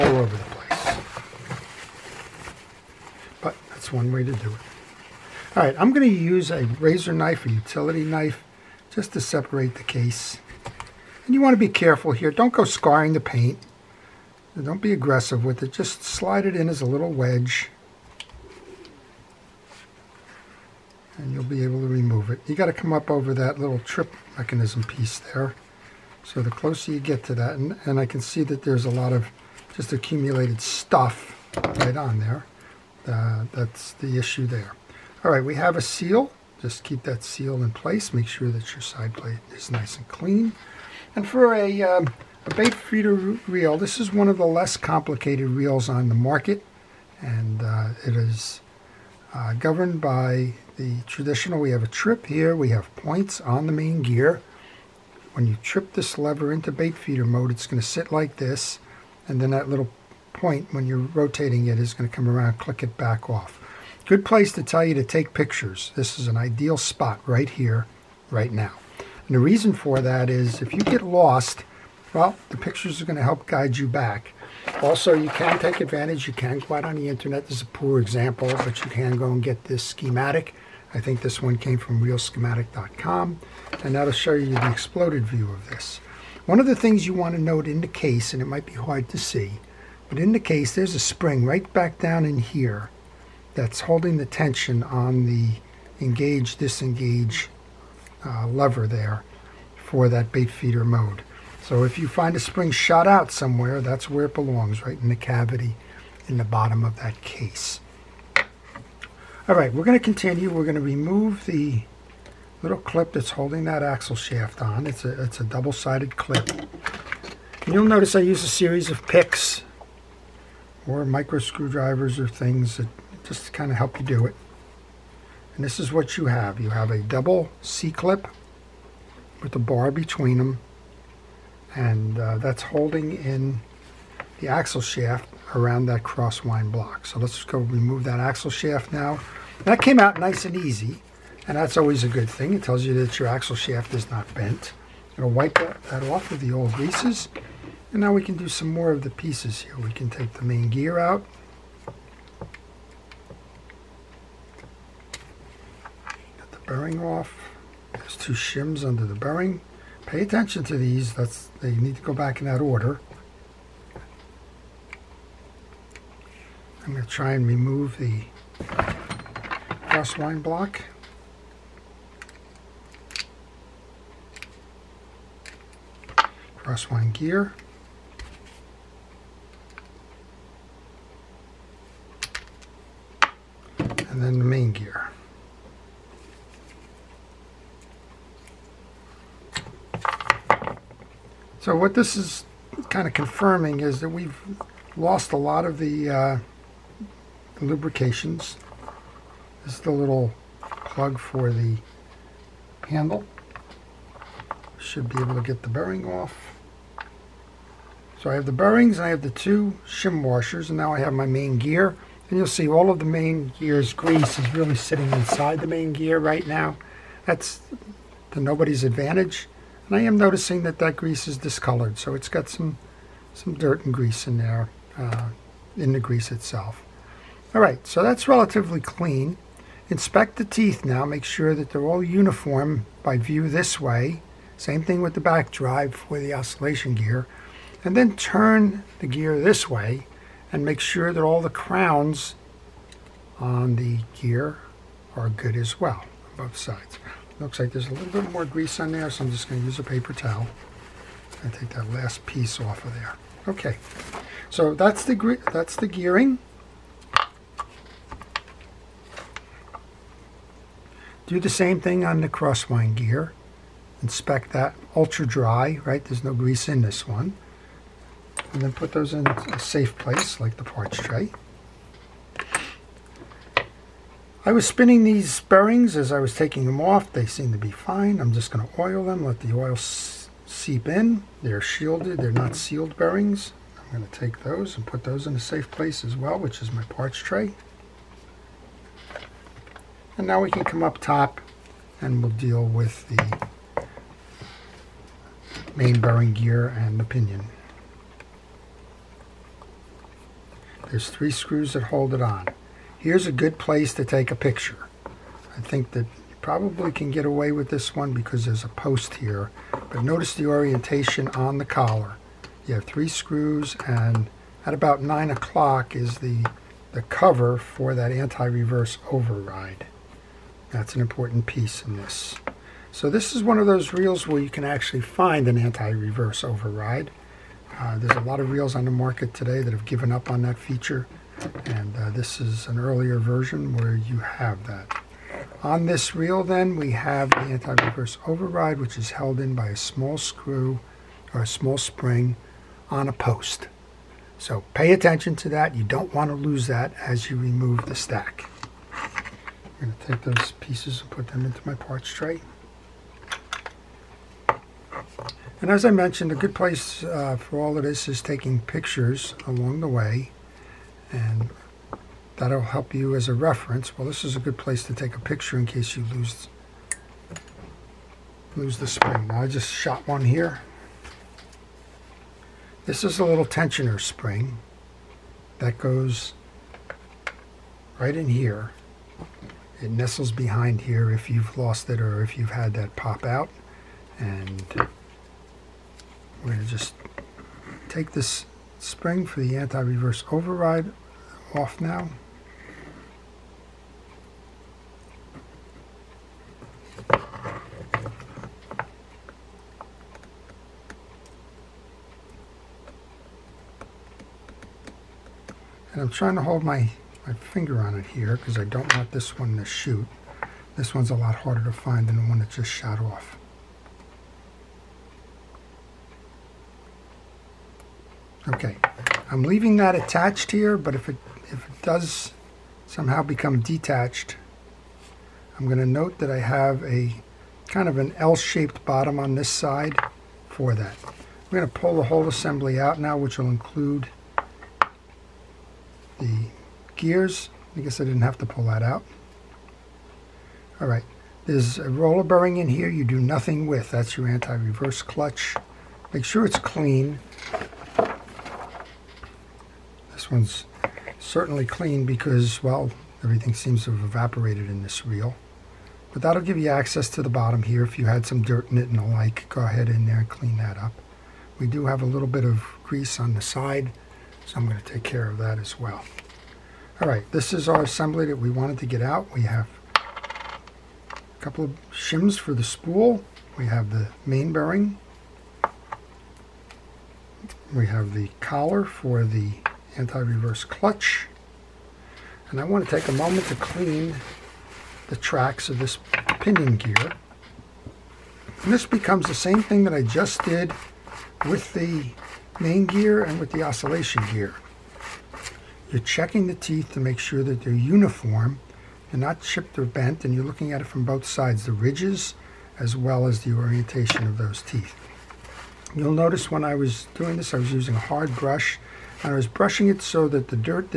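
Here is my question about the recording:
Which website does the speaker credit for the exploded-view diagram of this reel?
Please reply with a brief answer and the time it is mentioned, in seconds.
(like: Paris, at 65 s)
reelschematic.com, at 82 s.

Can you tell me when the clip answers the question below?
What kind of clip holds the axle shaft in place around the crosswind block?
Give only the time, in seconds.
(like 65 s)
115 s.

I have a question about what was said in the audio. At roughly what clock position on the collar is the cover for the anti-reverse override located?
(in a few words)
9 o'clock.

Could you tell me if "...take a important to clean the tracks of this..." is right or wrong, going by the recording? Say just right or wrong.
wrong.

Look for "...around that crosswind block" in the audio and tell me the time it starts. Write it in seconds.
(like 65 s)
135 s.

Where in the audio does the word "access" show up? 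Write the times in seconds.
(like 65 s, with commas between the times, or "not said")
456 s.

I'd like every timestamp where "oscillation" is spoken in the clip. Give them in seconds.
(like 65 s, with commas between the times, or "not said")
236 s, 493 s.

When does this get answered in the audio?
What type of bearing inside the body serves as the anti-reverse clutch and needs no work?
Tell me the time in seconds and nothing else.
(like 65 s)
441 s.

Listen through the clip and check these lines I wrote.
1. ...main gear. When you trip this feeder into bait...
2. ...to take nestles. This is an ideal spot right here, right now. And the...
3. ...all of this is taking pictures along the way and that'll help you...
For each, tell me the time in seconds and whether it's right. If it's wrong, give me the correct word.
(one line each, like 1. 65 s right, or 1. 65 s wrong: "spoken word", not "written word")
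1. 53 s wrong: "lever", not "feeder"
2. 64 s wrong: "pictures", not "nestles"
3. 357 s right.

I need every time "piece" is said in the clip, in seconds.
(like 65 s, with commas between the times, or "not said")
24 s, 149 s, 252 s, 321 s, 350 s.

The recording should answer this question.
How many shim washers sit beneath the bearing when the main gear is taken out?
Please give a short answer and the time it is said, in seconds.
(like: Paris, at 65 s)
2, at 158 s.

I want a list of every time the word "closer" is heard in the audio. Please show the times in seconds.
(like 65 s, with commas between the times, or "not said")
26 s.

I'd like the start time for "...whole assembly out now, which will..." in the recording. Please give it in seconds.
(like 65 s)
432 s.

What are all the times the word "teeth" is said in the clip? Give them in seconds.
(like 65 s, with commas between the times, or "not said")
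230 s, 496 s, 504 s.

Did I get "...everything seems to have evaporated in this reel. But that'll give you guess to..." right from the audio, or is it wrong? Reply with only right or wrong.
wrong.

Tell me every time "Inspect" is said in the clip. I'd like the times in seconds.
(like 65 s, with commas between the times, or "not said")
229 s, 264 s.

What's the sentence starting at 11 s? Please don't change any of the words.
And you want to be careful here.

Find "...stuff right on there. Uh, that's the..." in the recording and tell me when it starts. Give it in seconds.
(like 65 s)
30 s.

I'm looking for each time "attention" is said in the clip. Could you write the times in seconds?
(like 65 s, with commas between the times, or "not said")
160 s, 344 s.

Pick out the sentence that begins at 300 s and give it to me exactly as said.
There's three screws that hold it on here's a good place to take a picture.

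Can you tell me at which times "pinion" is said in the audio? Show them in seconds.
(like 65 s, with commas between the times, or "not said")
297 s, 486 s.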